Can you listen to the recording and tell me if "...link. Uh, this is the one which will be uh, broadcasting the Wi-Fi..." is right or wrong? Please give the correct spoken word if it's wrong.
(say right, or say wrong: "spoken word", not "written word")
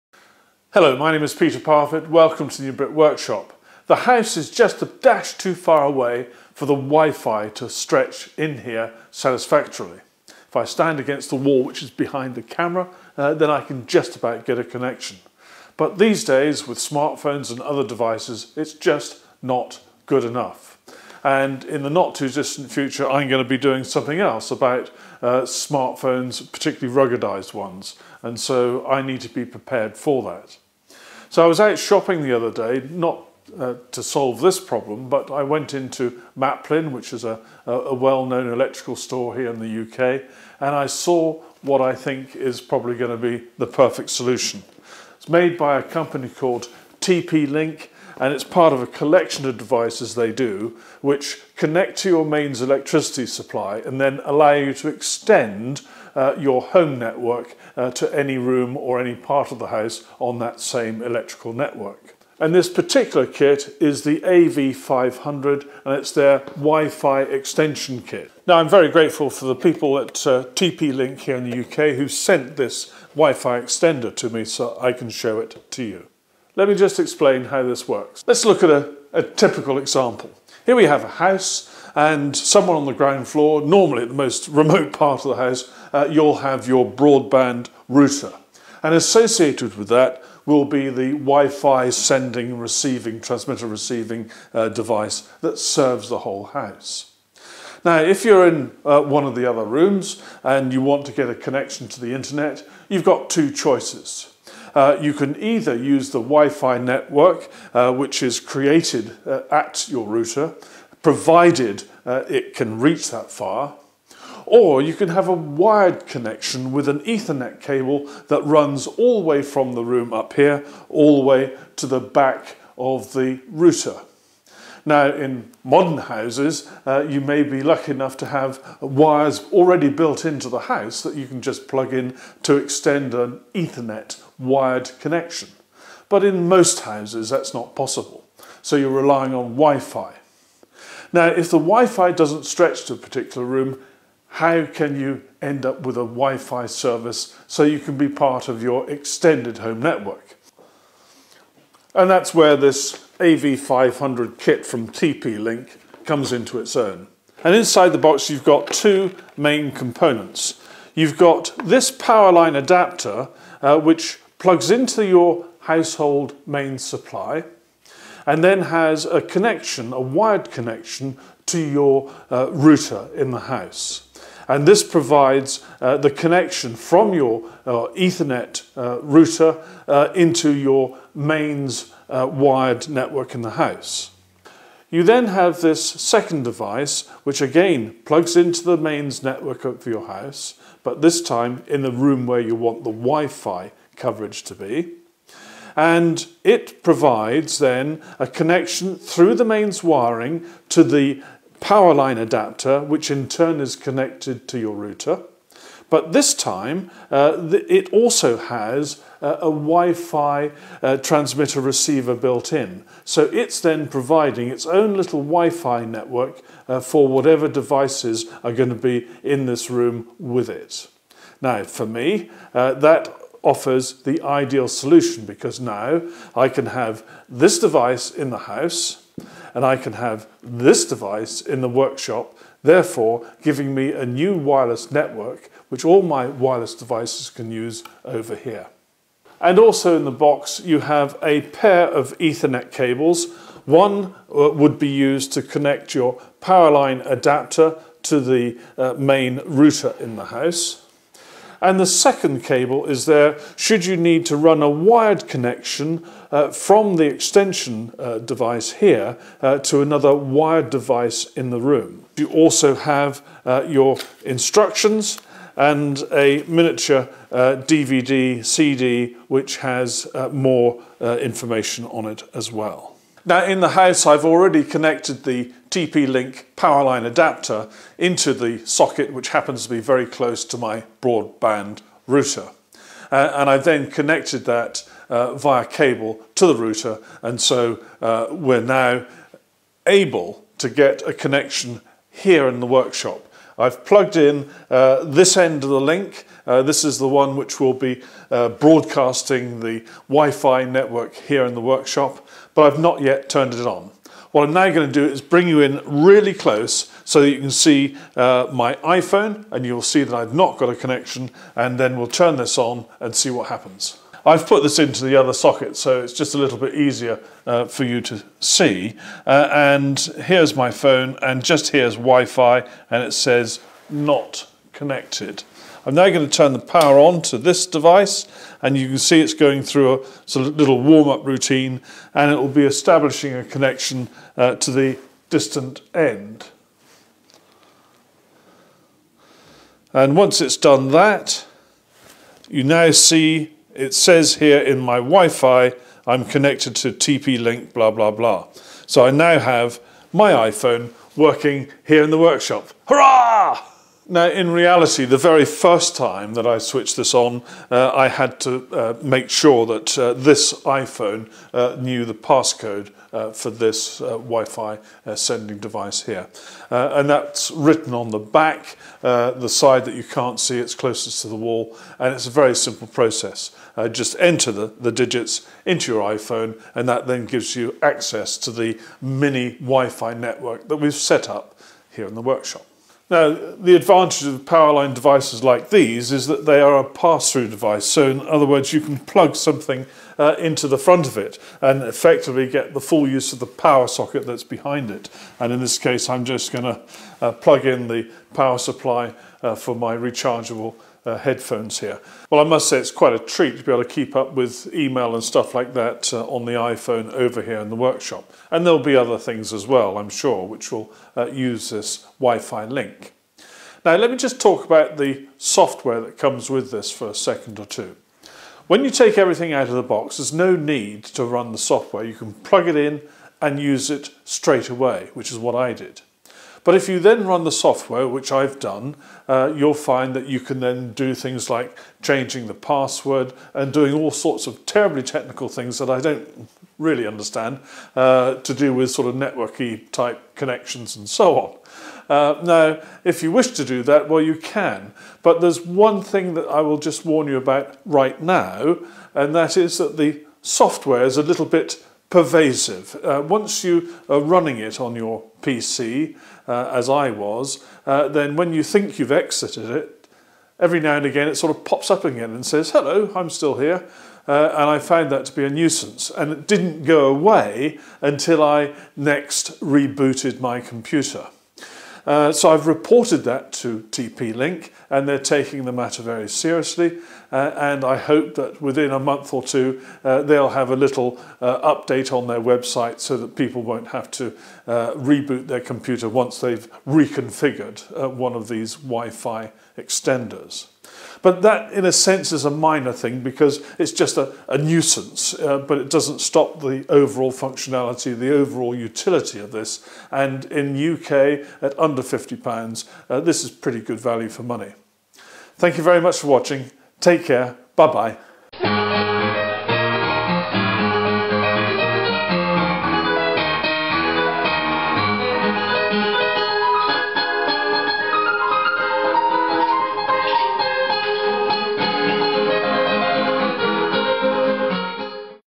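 right.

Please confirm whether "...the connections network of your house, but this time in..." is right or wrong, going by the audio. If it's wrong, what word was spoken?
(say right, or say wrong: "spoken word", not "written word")
wrong: "mains", not "connections".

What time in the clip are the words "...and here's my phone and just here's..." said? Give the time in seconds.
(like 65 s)
319 s.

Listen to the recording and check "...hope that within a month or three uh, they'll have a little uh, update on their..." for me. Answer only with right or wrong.
wrong.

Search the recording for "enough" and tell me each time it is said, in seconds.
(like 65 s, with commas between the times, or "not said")
20 s, 127 s.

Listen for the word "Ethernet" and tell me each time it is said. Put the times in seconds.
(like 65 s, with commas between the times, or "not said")
117 s, 133 s, 177 s, 242 s.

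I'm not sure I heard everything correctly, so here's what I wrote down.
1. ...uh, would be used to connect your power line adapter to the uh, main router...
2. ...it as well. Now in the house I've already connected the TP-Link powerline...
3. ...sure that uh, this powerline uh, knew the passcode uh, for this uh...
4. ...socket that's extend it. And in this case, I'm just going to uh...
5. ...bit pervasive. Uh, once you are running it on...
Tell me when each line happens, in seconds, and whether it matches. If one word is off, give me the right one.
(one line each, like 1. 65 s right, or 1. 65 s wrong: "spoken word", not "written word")
1. 244 s right
2. 272 s right
3. 359 s wrong: "iPhone", not "powerline"
4. 393 s wrong: "behind", not "extend"
5. 451 s right.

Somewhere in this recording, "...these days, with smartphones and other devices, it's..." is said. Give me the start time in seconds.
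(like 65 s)
15 s.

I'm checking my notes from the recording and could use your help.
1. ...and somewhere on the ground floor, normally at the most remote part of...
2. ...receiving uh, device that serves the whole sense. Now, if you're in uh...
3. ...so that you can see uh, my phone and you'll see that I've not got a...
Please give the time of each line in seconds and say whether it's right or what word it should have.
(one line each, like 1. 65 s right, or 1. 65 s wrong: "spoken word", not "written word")
1. 81 s right
2. 93 s wrong: "house", not "sense"
3. 307 s wrong: "iPhone", not "phone".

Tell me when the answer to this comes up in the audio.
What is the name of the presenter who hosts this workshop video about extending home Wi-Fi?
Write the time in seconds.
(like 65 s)
1 s.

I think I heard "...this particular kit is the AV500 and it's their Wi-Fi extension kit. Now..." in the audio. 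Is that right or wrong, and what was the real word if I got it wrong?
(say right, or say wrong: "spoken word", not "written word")
right.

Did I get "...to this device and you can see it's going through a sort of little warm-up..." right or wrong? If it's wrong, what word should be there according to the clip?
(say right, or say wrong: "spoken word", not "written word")
right.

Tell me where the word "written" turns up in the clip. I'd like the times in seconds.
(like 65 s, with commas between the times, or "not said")
367 s.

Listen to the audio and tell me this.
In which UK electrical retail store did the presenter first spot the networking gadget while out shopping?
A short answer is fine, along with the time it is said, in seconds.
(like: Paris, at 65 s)
Maplin, at 36 s.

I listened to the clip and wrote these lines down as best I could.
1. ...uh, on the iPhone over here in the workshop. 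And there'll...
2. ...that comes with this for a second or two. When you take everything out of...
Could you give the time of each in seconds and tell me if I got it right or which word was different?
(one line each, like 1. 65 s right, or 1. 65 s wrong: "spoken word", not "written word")
1. 406 s right
2. 416 s right.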